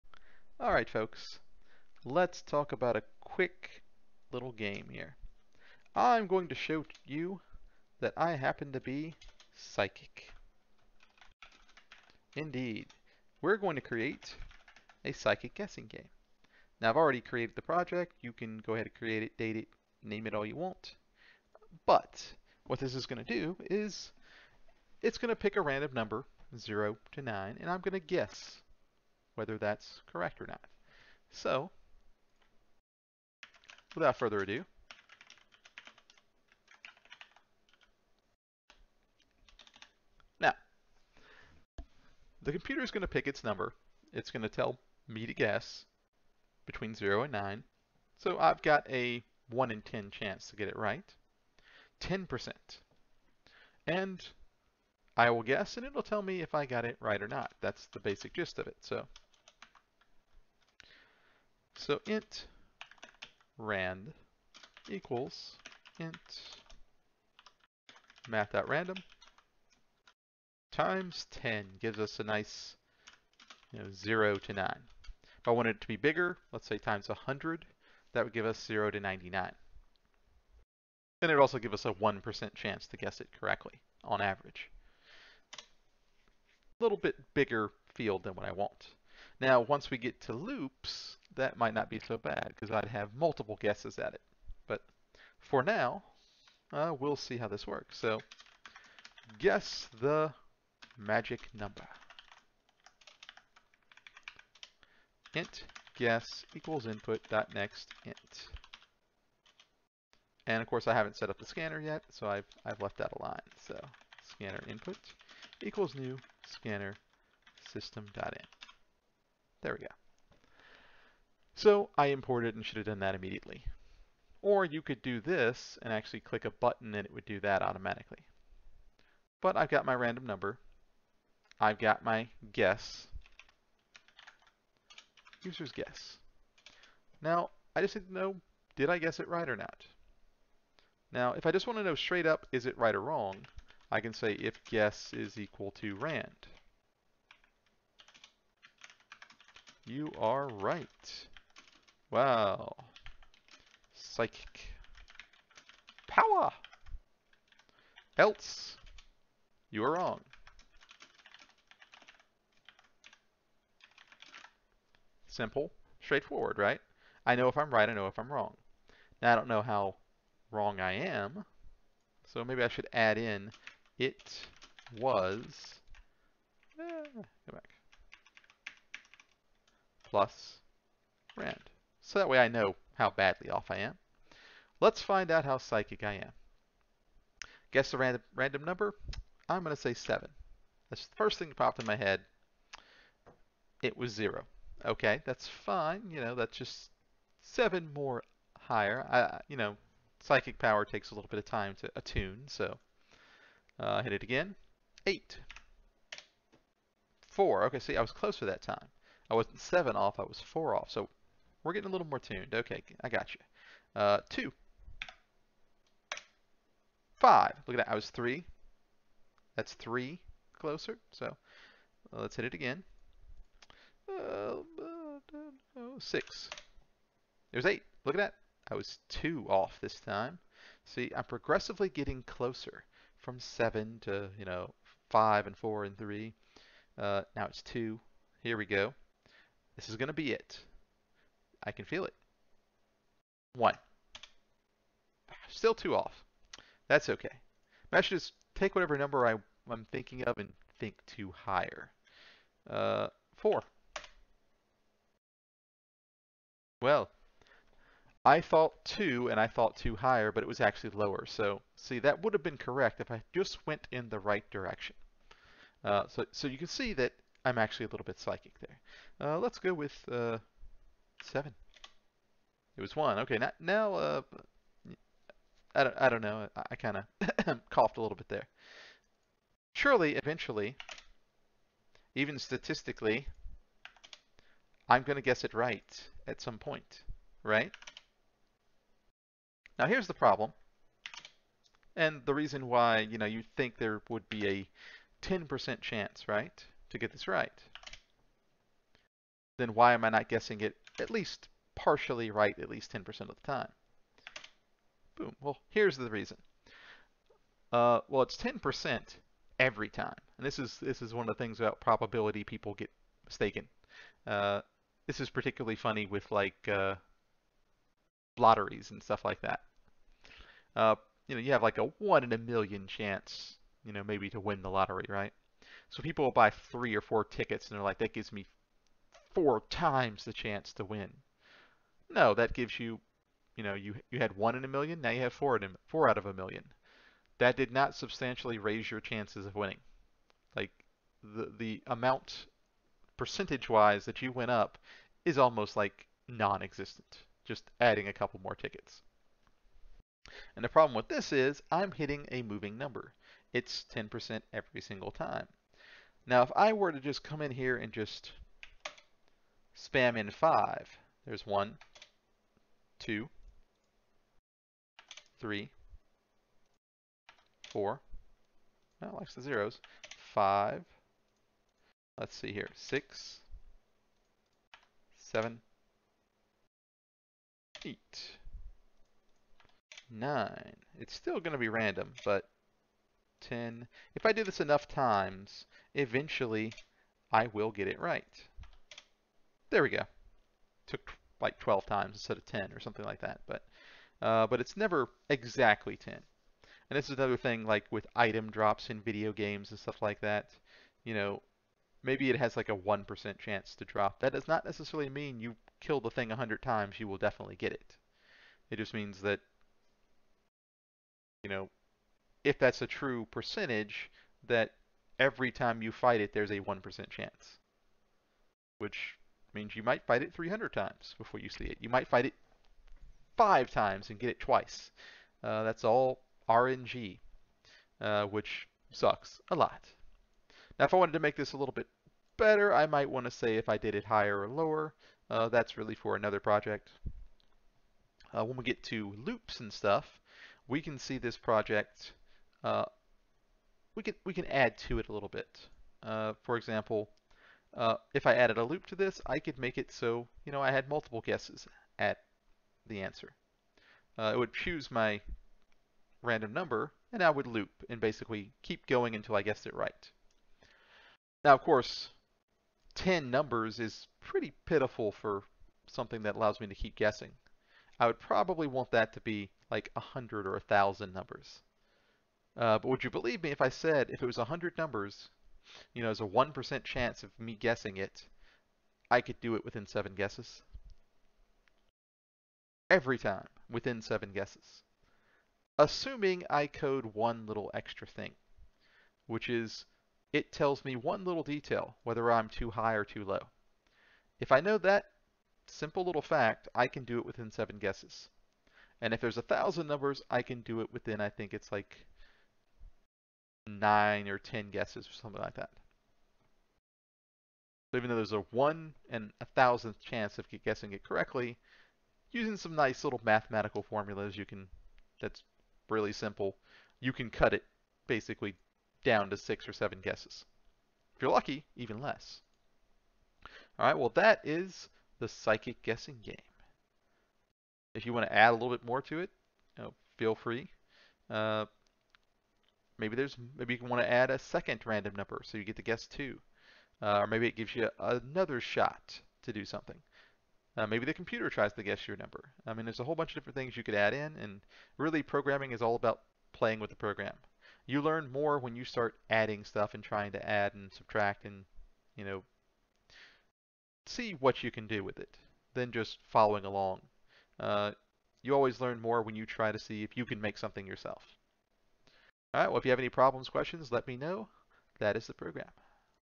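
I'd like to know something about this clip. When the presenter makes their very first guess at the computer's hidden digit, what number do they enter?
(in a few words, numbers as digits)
7.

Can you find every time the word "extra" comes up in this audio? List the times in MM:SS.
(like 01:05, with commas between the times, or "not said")
08:07.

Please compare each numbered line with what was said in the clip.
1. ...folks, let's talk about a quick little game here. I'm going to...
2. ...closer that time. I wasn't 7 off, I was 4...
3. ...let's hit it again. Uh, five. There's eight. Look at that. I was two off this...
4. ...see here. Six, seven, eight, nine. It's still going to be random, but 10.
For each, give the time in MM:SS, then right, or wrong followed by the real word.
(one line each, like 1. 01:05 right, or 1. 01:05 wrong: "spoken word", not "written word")
1. 00:00 right
2. 03:28 right
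3. 03:42 wrong: "six", not "five"
4. 06:12 right.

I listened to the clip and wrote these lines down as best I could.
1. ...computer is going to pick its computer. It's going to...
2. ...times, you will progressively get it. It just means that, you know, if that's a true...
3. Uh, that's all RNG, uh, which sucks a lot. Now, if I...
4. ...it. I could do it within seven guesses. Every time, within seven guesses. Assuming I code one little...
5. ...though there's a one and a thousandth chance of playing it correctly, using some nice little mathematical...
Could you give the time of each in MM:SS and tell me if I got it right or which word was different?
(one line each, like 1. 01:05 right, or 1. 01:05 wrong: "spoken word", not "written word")
1. 00:42 wrong: "number", not "computer"
2. 06:46 wrong: "definitely", not "progressively"
3. 07:05 right
4. 07:57 right
5. 08:28 wrong: "guessing", not "playing".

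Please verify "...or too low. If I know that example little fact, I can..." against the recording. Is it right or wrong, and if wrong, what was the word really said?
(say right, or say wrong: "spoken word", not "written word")
wrong: "simple", not "example".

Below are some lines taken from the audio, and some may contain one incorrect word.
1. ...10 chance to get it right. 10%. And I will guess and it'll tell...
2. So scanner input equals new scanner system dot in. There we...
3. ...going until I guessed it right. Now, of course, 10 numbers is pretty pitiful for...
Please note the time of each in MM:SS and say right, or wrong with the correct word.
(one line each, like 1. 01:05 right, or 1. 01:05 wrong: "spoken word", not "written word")
1. 00:49 right
2. 01:53 right
3. 07:38 right.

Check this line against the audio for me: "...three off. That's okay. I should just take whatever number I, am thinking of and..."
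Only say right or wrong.
wrong.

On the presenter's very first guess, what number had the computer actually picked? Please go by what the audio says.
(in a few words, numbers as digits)
0.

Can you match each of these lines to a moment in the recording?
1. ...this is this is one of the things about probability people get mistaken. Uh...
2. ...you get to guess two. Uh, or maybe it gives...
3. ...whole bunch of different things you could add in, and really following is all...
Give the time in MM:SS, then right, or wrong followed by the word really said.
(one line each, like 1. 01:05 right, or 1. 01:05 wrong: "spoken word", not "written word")
1. 05:10 right
2. 08:55 right
3. 09:03 wrong: "programming", not "following".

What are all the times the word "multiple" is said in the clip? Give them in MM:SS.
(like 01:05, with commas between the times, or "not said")
01:33, 07:30.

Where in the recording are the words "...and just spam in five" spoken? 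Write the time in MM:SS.
05:57.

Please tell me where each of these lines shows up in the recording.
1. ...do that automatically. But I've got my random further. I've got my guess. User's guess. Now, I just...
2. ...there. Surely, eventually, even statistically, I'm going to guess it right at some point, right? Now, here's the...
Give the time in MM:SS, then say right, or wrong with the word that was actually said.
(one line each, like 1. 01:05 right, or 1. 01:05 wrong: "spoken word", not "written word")
1. 02:07 wrong: "number", not "further"
2. 04:38 right.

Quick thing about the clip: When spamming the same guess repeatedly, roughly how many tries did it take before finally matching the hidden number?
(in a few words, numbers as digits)
12.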